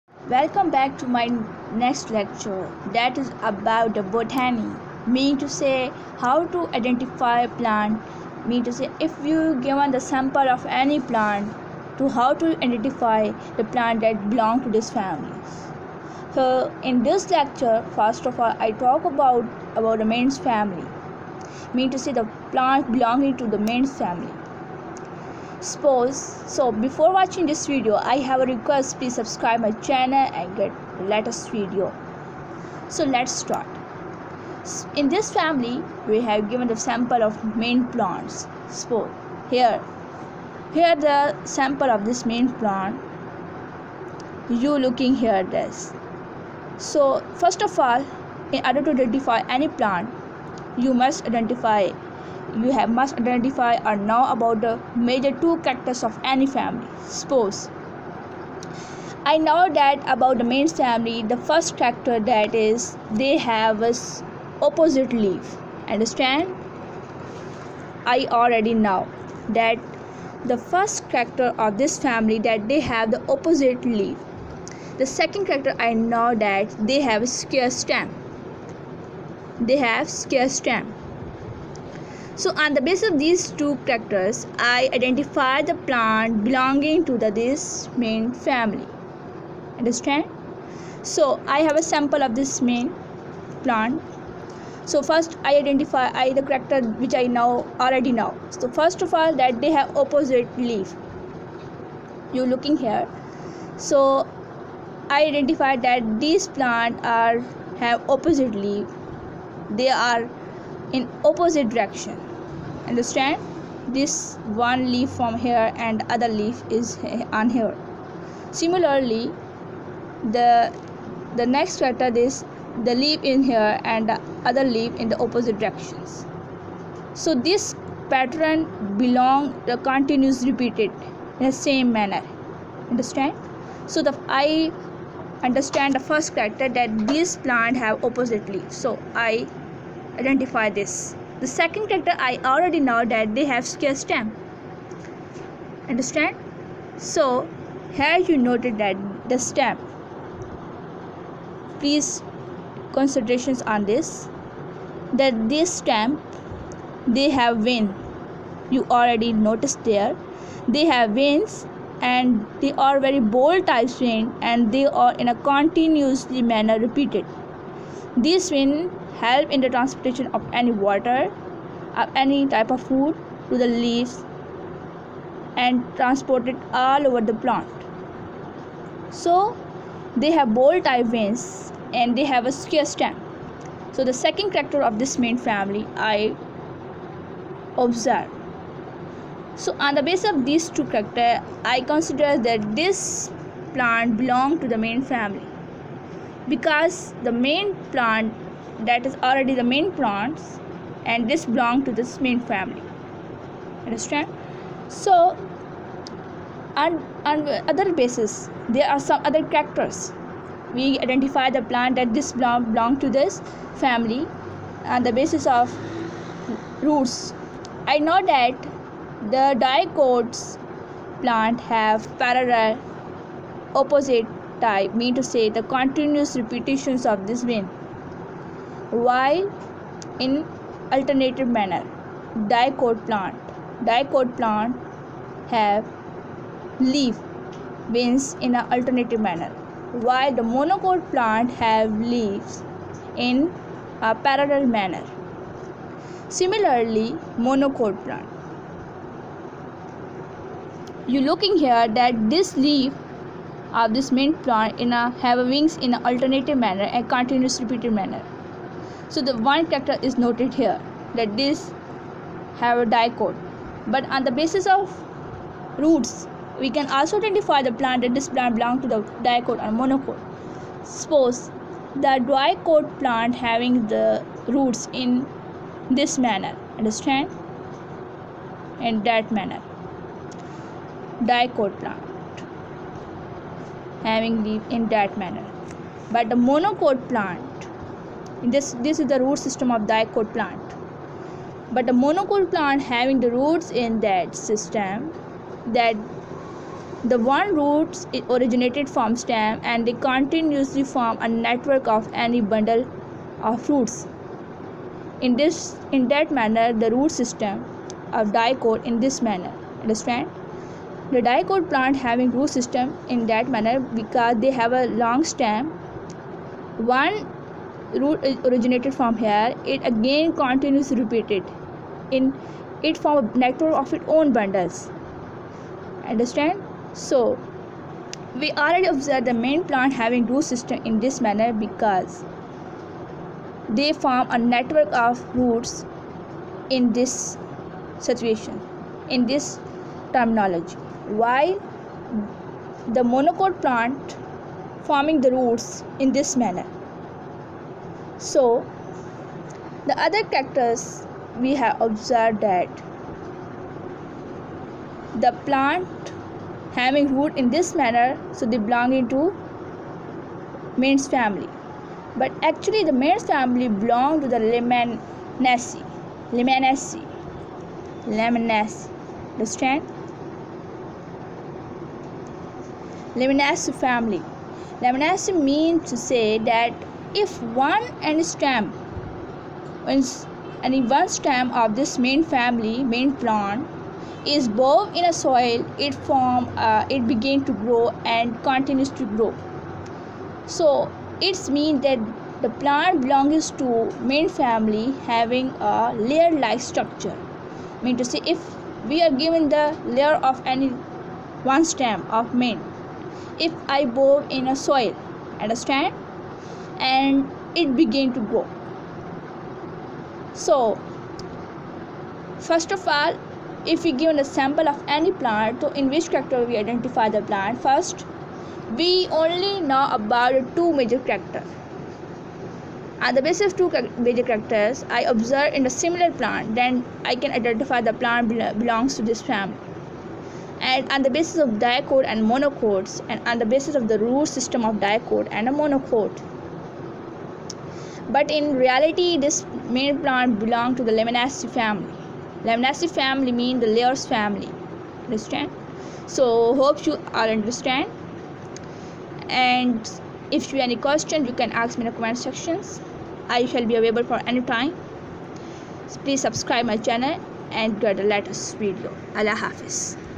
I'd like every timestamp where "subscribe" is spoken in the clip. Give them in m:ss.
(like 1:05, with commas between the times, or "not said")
0:29, 7:36.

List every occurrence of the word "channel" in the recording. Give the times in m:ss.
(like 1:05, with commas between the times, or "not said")
0:29, 7:36.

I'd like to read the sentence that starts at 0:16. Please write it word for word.
So in this lecture first of all I talk about about the mains family.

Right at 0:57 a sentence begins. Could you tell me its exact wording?
Suppose I know that about the mint family, the first character that is they have a opposite leaf.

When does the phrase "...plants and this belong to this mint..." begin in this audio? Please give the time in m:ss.
3:19.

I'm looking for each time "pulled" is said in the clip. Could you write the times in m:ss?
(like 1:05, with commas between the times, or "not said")
not said.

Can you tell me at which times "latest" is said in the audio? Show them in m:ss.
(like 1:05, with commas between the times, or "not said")
0:31, 7:38.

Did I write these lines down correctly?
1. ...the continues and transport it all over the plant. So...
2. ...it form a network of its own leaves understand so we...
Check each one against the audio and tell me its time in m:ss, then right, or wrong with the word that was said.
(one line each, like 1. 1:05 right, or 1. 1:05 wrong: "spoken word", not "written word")
1. 2:53 wrong: "leaves", not "continues"
2. 5:22 wrong: "bundles", not "leaves".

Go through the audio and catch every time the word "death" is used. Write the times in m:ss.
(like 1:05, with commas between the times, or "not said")
not said.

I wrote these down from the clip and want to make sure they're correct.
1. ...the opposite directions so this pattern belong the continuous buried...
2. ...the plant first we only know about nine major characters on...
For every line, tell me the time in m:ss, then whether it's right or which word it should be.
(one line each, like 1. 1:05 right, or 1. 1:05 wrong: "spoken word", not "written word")
1. 2:05 wrong: "repeated", not "buried"
2. 6:57 wrong: "two", not "nine".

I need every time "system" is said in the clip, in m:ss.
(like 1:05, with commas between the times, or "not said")
4:49, 4:54, 5:07, 5:12, 5:30, 7:14.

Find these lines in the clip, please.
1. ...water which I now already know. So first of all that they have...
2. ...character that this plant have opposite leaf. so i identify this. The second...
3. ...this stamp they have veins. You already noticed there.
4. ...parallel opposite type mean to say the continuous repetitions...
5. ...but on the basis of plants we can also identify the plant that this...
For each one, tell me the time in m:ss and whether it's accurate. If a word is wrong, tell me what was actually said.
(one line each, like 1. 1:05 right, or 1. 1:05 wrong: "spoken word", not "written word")
1. 1:36 wrong: "character", not "water"
2. 2:16 right
3. 2:35 right
4. 3:42 right
5. 4:23 wrong: "roots", not "plants".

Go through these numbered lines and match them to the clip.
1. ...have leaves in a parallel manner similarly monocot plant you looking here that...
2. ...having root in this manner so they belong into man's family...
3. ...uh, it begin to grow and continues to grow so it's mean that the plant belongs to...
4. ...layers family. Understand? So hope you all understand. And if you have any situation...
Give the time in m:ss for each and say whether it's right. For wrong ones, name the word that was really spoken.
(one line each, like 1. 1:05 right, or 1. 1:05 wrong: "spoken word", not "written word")
1. 4:01 right
2. 5:56 right
3. 6:26 right
4. 7:23 wrong: "question", not "situation".